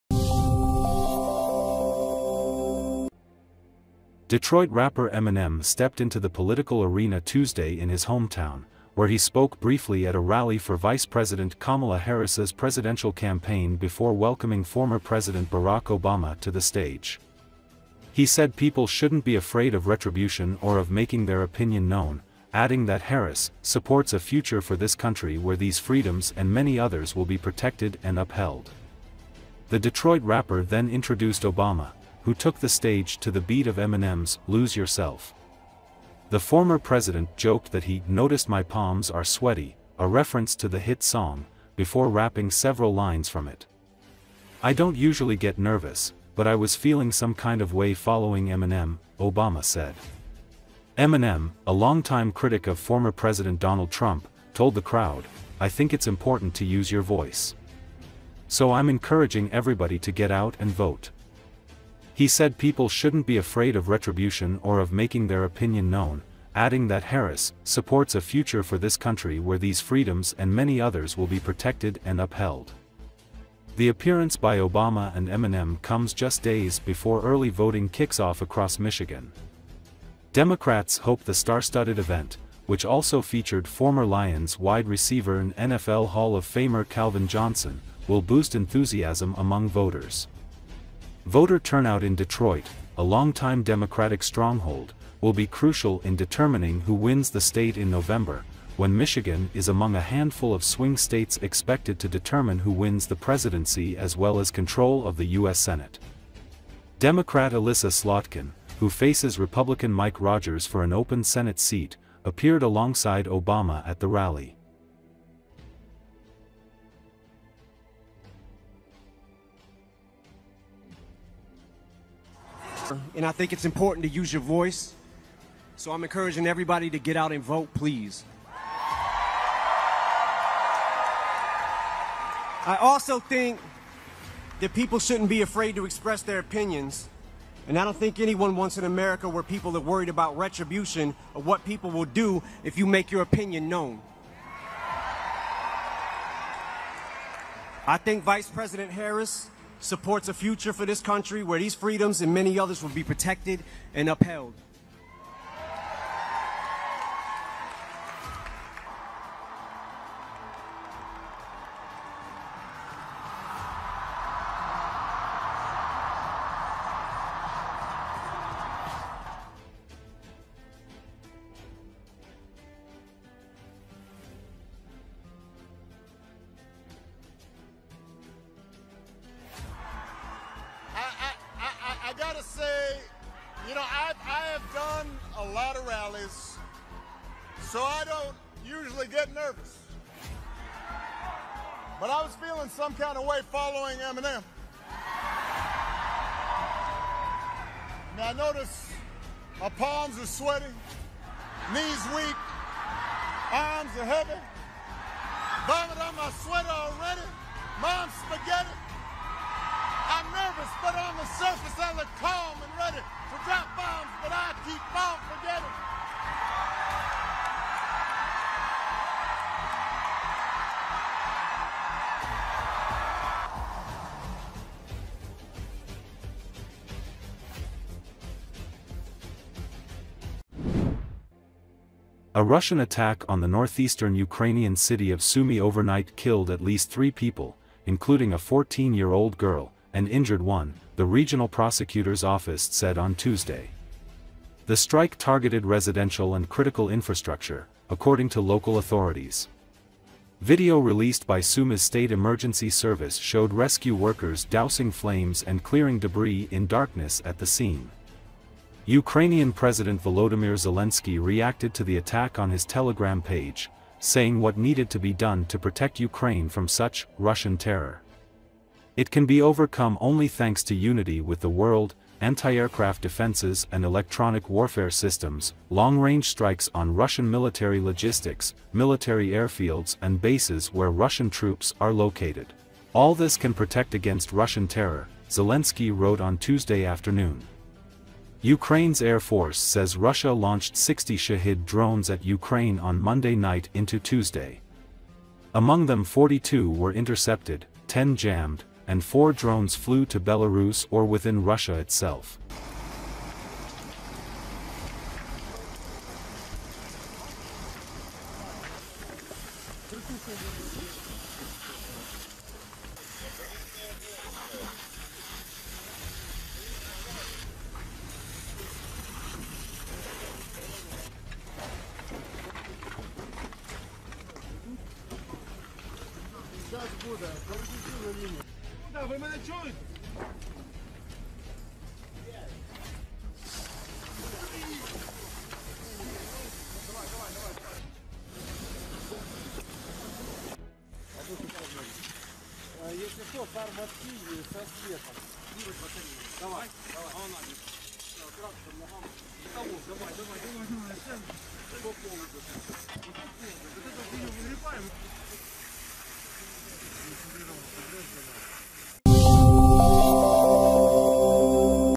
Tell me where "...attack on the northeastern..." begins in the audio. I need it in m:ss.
3:52.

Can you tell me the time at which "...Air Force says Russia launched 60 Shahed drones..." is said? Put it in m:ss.
4:49.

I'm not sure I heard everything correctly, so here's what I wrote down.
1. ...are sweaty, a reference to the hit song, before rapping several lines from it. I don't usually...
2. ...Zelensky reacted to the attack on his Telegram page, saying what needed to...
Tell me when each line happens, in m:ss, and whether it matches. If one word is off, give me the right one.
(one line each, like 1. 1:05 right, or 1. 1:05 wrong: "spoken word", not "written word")
1. 0:39 right
2. 4:20 right.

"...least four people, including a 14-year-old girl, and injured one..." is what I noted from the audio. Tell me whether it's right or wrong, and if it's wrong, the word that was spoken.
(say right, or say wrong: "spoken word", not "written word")
wrong: "three", not "four".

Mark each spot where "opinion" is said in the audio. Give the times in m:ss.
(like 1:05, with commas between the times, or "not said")
0:21, 1:05, 2:16, 2:23.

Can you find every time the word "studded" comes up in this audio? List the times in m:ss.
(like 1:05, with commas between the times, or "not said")
1:21.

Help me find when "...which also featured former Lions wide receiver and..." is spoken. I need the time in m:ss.
1:22.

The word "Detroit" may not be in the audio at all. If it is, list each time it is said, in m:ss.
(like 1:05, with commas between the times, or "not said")
0:04, 0:29, 1:32.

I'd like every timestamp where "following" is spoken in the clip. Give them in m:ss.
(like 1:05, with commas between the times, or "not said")
0:47, 3:13.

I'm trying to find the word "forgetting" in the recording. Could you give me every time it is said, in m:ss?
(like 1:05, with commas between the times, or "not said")
3:35.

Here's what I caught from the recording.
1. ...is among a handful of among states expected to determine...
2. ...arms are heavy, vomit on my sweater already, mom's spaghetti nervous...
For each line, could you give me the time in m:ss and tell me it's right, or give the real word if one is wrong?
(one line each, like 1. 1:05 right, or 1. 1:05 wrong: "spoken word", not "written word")
1. 1:39 wrong: "swing", not "among"
2. 3:23 right.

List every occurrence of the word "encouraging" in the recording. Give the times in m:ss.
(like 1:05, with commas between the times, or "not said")
0:58, 2:06.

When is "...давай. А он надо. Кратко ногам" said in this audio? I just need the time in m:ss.
5:46.